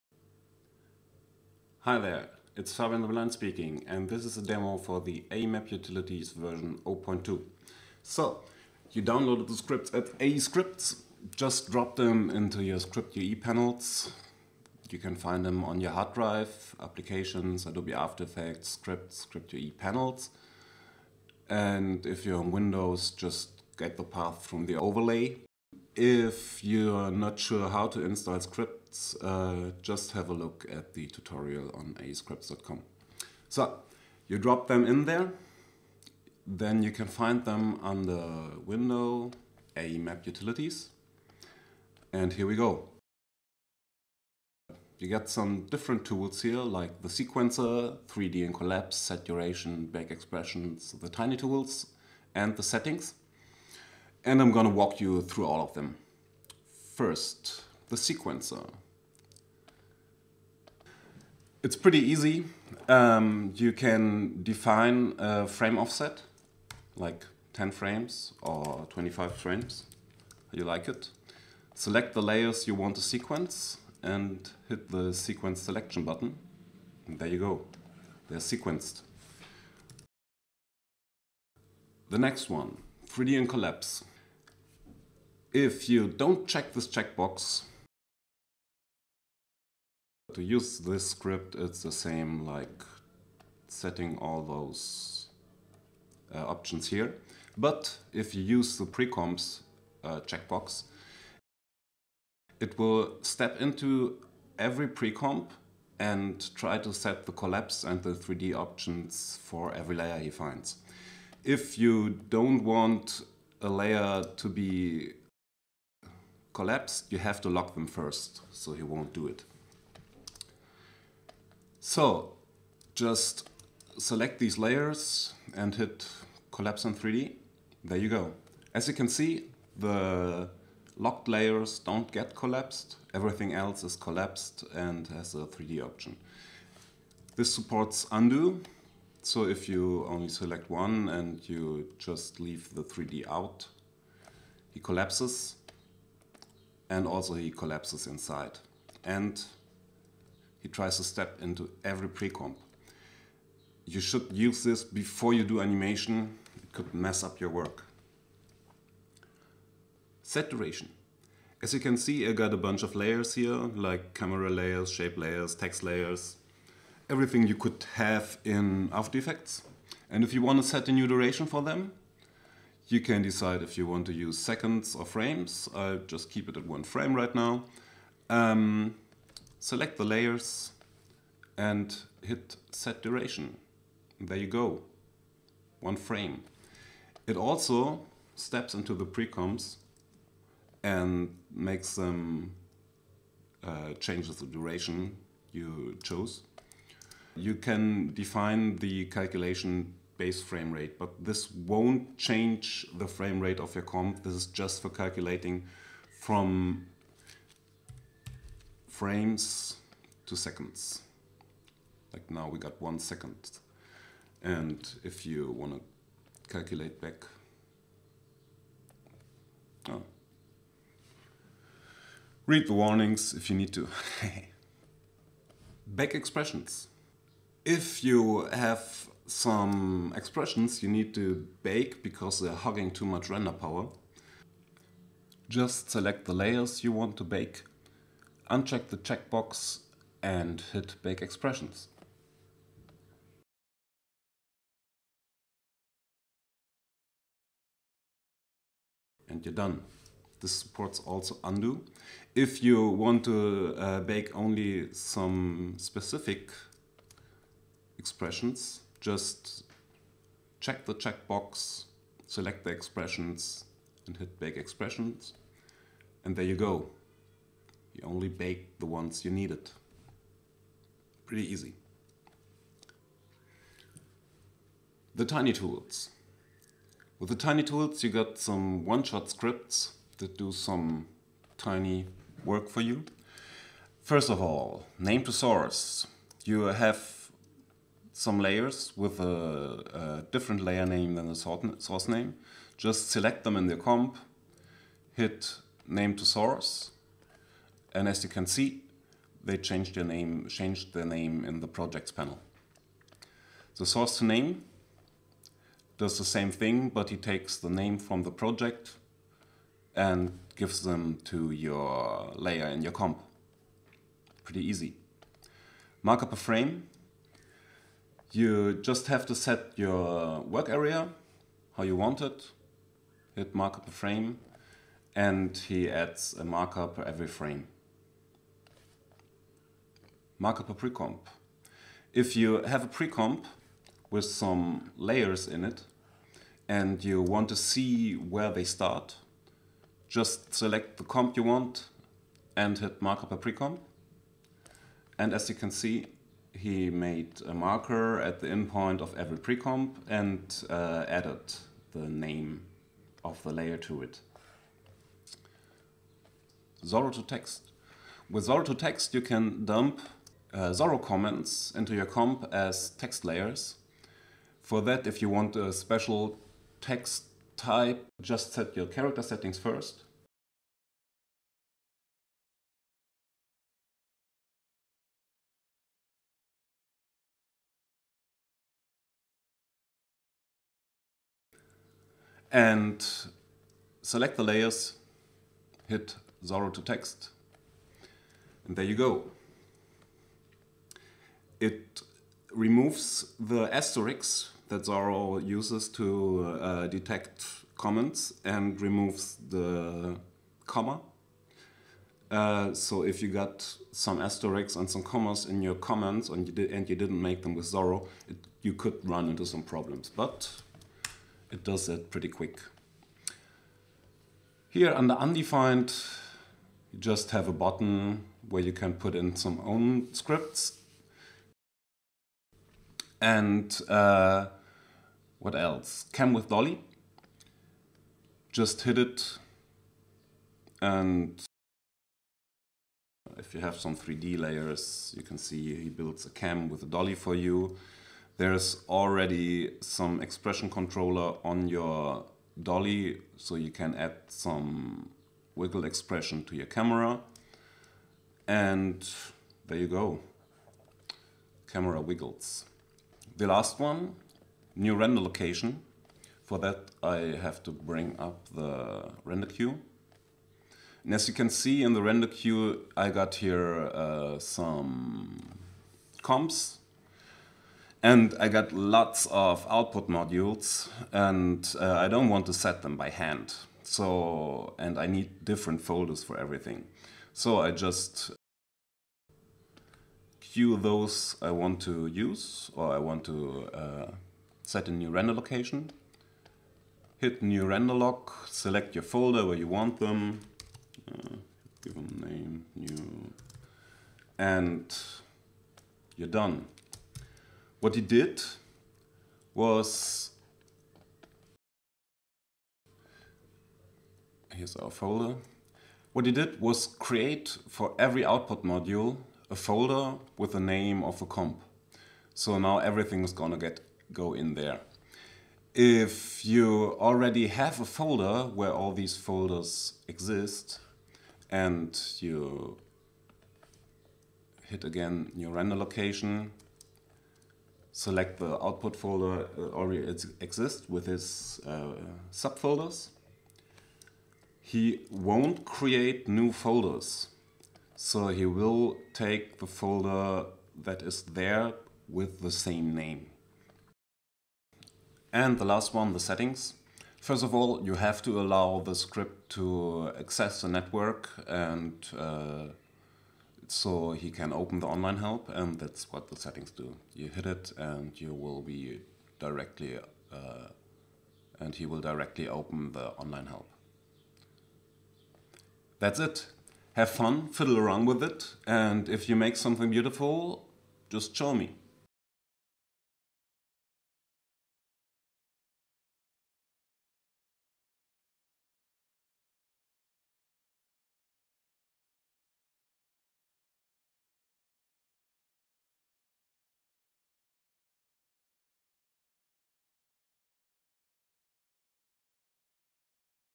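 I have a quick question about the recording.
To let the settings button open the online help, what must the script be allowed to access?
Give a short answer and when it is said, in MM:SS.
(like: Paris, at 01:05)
the network, at 09:10.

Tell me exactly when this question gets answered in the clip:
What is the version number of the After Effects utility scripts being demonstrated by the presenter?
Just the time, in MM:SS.
00:06.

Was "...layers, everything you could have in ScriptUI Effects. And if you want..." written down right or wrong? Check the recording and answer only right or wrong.
wrong.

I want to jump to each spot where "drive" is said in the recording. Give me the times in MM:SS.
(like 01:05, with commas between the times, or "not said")
00:16.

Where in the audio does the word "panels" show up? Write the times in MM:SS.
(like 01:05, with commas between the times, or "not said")
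00:13, 00:19, 05:02.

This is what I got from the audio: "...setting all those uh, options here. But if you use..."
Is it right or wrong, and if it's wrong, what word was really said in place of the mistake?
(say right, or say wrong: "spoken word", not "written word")
right.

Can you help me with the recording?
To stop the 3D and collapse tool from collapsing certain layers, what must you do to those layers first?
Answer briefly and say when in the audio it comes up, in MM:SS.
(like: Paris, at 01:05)
Lock them, at 01:57.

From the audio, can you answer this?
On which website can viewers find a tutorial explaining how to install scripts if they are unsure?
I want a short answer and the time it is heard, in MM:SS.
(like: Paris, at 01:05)
aescripts.com, at 00:31.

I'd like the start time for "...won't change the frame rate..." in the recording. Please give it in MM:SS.
03:21.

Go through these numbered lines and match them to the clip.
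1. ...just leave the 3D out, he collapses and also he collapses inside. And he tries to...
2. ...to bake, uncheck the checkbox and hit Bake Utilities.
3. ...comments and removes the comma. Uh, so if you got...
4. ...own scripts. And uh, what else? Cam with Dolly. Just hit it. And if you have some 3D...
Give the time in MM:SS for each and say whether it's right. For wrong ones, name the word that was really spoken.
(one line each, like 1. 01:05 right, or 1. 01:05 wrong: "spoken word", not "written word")
1. 02:21 right
2. 03:57 wrong: "Expressions", not "Utilities"
3. 06:37 right
4. 06:59 right.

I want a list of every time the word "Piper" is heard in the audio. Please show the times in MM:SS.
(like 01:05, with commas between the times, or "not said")
not said.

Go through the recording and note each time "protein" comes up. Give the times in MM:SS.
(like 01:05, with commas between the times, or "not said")
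not said.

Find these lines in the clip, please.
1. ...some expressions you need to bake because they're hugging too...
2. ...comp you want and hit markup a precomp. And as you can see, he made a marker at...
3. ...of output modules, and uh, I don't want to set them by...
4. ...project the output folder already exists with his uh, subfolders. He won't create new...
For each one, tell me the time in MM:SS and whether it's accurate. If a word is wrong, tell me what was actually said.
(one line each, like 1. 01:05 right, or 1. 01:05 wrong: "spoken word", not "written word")
1. 03:49 right
2. 05:41 right
3. 07:49 right
4. 08:47 wrong: "select", not "project".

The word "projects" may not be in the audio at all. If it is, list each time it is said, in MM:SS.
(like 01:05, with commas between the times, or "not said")
05:01, 05:08.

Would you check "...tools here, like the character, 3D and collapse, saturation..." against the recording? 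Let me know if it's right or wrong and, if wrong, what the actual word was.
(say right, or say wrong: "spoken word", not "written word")
wrong: "sequencer", not "character".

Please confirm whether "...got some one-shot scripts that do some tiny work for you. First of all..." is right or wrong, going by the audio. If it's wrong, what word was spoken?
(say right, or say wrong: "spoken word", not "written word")
right.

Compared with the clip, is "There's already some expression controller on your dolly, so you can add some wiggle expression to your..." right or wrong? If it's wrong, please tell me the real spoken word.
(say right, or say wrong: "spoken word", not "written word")
right.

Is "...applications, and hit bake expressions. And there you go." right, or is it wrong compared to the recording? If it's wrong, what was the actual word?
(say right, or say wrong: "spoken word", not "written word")
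wrong: "expressions", not "applications".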